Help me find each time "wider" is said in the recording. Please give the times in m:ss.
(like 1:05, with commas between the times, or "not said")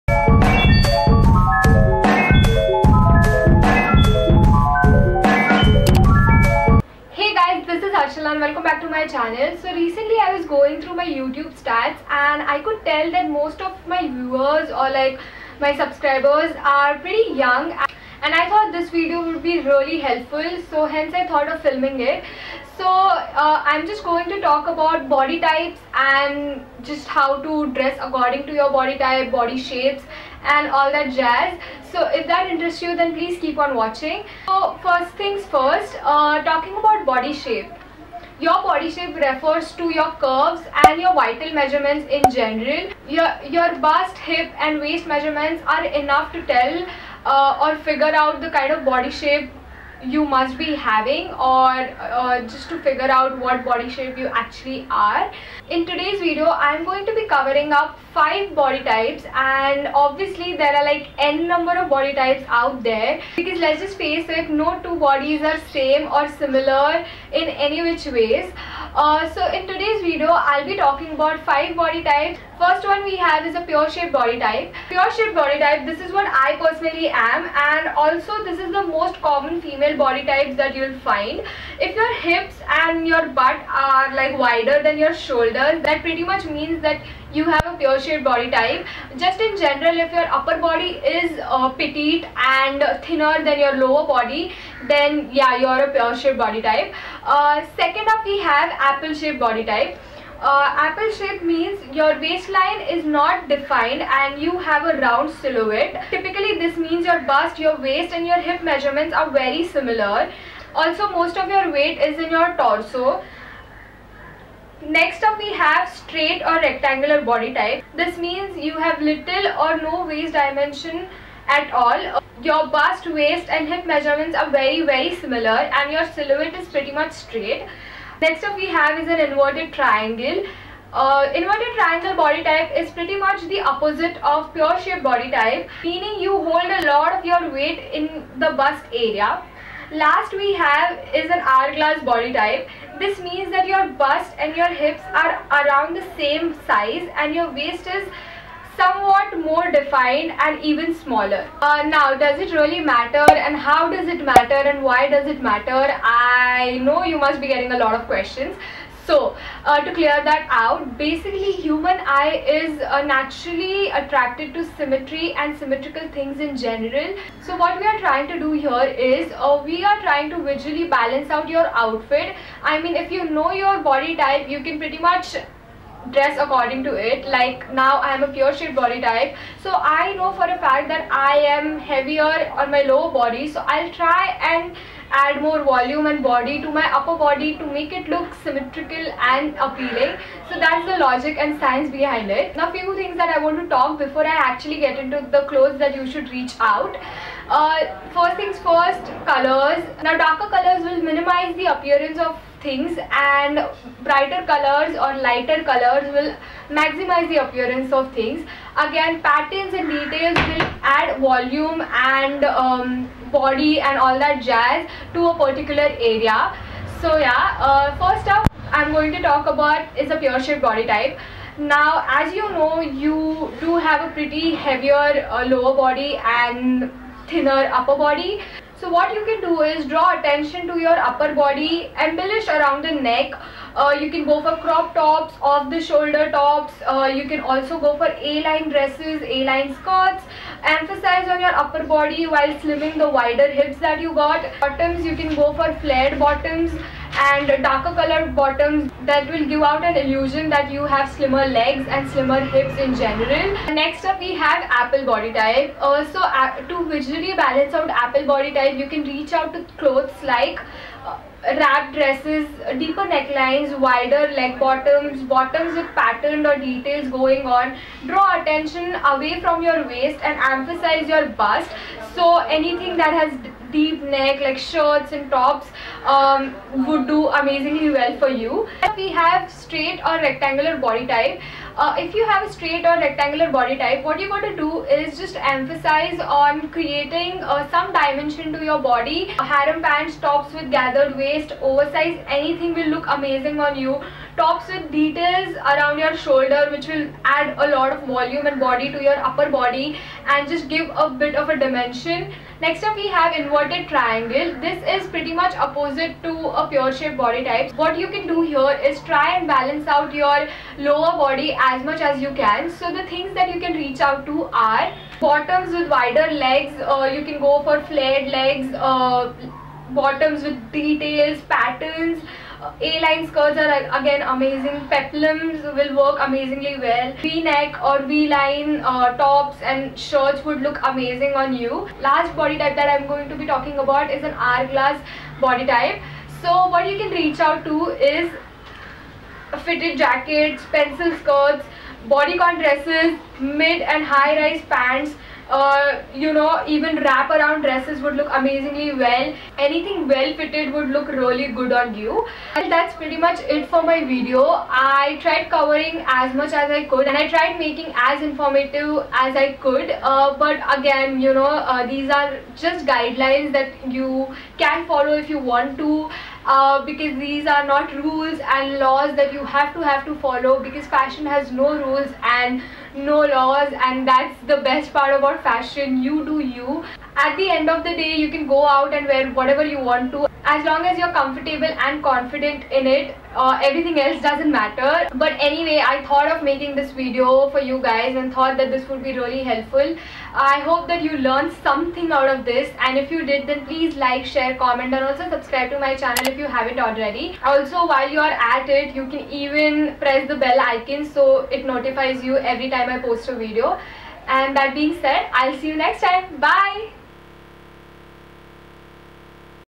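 1:24, 4:03, 4:23, 5:15.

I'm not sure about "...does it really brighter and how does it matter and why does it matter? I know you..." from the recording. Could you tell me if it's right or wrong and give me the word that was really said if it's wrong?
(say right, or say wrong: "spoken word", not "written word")
wrong: "matter", not "brighter".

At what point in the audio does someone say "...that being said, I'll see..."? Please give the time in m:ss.
6:44.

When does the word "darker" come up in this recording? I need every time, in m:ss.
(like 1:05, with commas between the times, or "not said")
3:20, 4:07.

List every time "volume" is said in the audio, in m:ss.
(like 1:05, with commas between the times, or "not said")
3:05, 3:31, 4:58.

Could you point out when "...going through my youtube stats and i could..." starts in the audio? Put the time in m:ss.
0:10.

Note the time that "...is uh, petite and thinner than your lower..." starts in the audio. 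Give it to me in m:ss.
1:31.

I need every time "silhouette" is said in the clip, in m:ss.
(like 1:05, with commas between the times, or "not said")
1:45, 2:06.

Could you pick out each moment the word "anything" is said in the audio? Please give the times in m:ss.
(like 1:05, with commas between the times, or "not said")
4:32, 4:52, 5:49.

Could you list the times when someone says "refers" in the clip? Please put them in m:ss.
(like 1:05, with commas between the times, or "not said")
0:39.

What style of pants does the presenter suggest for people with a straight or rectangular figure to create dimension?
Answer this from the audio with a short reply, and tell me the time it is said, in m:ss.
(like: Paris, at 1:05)
Harem pants, at 4:49.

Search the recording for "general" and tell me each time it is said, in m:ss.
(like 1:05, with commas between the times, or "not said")
0:42, 1:29, 2:46, 4:13.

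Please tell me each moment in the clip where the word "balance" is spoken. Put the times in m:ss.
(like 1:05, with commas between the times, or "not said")
2:50, 4:17, 5:09.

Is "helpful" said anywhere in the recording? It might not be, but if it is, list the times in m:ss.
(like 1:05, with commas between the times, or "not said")
0:19, 6:29.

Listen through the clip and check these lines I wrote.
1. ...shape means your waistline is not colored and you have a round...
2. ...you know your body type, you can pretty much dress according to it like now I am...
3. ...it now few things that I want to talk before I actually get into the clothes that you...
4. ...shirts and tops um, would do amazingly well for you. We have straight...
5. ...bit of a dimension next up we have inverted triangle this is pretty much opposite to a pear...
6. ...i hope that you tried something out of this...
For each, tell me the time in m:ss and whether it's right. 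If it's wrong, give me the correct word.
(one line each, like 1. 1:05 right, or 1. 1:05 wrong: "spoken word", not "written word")
1. 1:41 wrong: "defined", not "colored"
2. 2:53 right
3. 3:12 right
4. 4:34 right
5. 5:01 right
6. 6:30 wrong: "learned", not "tried".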